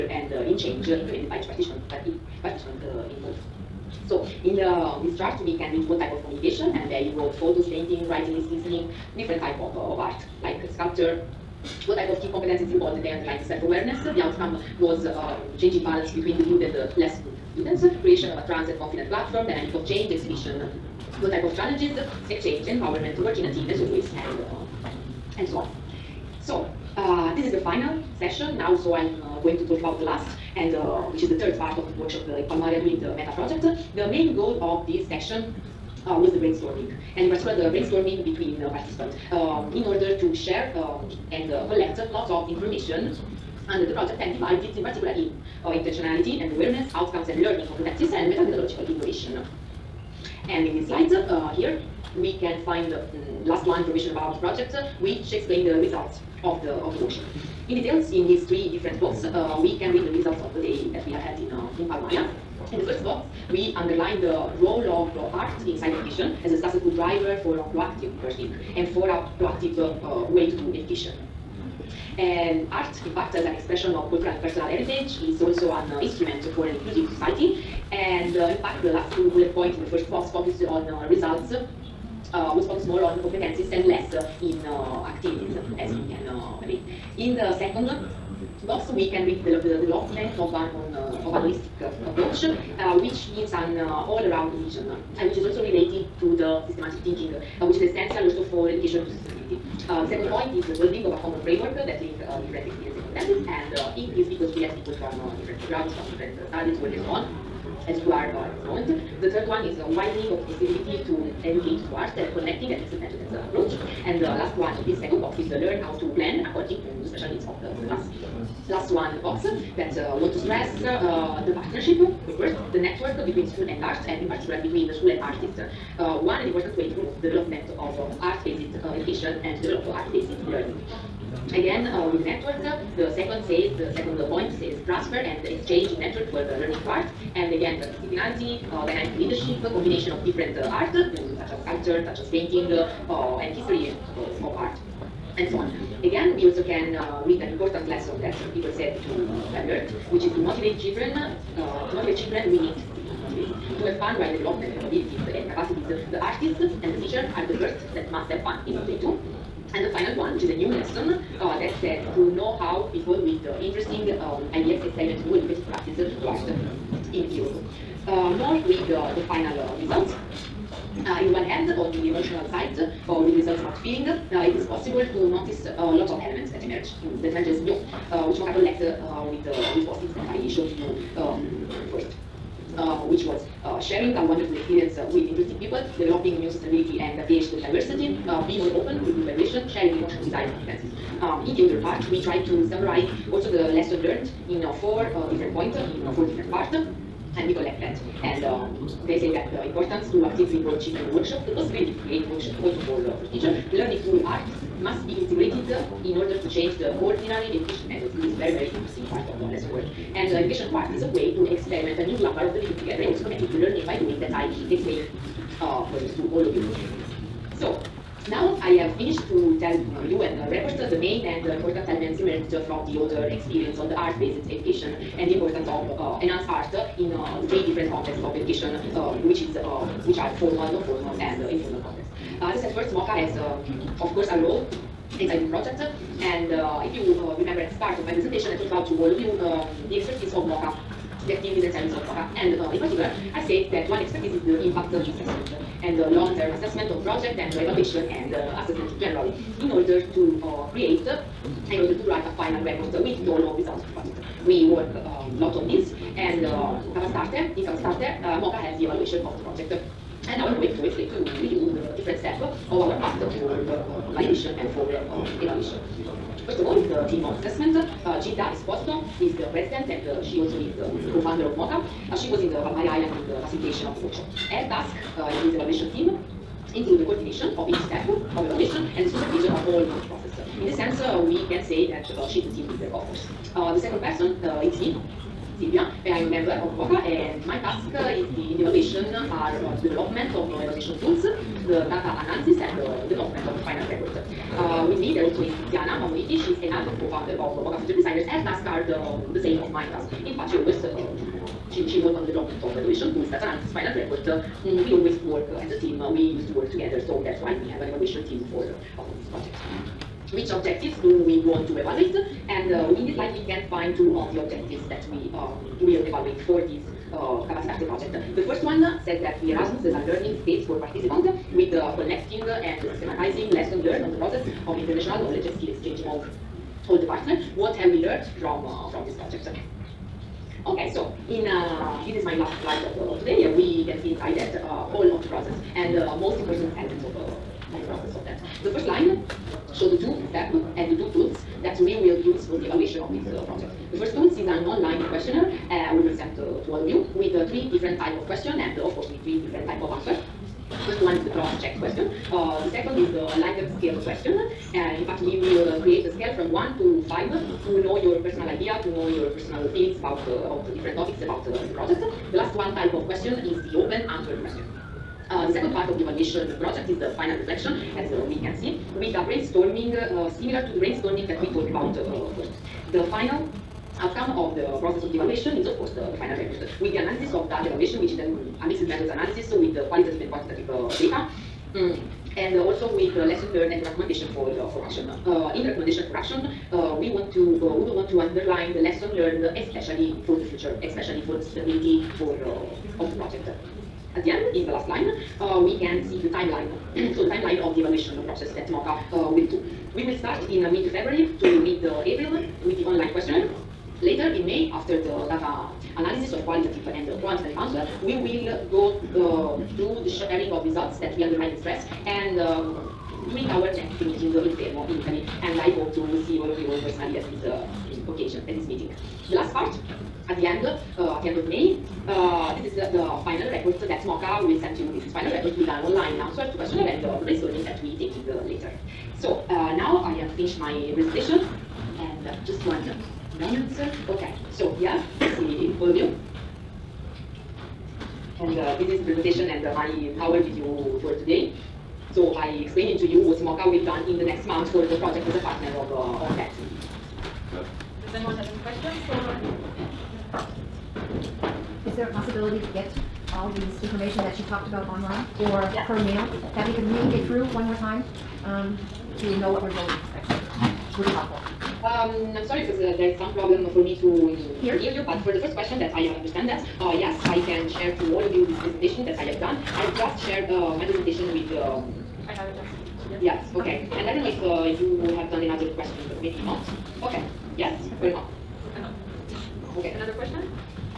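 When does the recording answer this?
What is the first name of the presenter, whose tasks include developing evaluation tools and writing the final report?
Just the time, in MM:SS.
04:45.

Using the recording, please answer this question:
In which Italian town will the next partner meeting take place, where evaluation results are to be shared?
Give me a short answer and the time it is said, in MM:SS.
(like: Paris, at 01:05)
Fermo, at 06:54.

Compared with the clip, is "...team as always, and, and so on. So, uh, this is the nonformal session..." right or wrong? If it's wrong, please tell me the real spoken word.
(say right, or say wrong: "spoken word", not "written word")
wrong: "final", not "nonformal".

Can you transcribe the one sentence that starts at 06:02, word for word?
The last one type of question is the open answer question.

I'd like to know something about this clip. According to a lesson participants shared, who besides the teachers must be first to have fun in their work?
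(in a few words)
The artists.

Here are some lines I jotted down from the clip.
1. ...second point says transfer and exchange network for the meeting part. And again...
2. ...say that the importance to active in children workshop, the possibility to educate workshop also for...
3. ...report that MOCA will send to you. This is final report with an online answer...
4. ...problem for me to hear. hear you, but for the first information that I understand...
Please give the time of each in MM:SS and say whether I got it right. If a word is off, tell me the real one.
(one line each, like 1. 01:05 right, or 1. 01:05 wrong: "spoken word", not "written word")
1. 02:13 wrong: "learning", not "meeting"
2. 03:19 wrong: "create", not "educate"
3. 07:03 right
4. 07:43 wrong: "question", not "information".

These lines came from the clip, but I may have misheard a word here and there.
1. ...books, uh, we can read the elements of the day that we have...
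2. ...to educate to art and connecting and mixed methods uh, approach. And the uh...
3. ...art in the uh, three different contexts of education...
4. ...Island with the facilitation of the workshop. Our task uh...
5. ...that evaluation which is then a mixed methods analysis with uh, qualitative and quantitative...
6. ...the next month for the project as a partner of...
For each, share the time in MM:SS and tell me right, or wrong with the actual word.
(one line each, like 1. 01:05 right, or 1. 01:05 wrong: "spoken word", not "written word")
1. 00:59 wrong: "results", not "elements"
2. 01:51 right
3. 03:46 right
4. 04:32 right
5. 06:17 right
6. 07:24 right.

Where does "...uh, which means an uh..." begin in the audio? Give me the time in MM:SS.
01:32.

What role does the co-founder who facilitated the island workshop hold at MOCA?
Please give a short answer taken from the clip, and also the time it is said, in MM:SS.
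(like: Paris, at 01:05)
President, at 04:29.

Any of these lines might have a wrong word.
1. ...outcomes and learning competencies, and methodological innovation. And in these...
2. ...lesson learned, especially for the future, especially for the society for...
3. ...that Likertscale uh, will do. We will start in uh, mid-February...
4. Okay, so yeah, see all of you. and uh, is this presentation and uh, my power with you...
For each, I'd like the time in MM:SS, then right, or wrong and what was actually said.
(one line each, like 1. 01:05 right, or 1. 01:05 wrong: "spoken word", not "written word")
1. 00:46 right
2. 06:28 wrong: "stability", not "society"
3. 06:38 wrong: "MOCA", not "Likertscale"
4. 07:14 right.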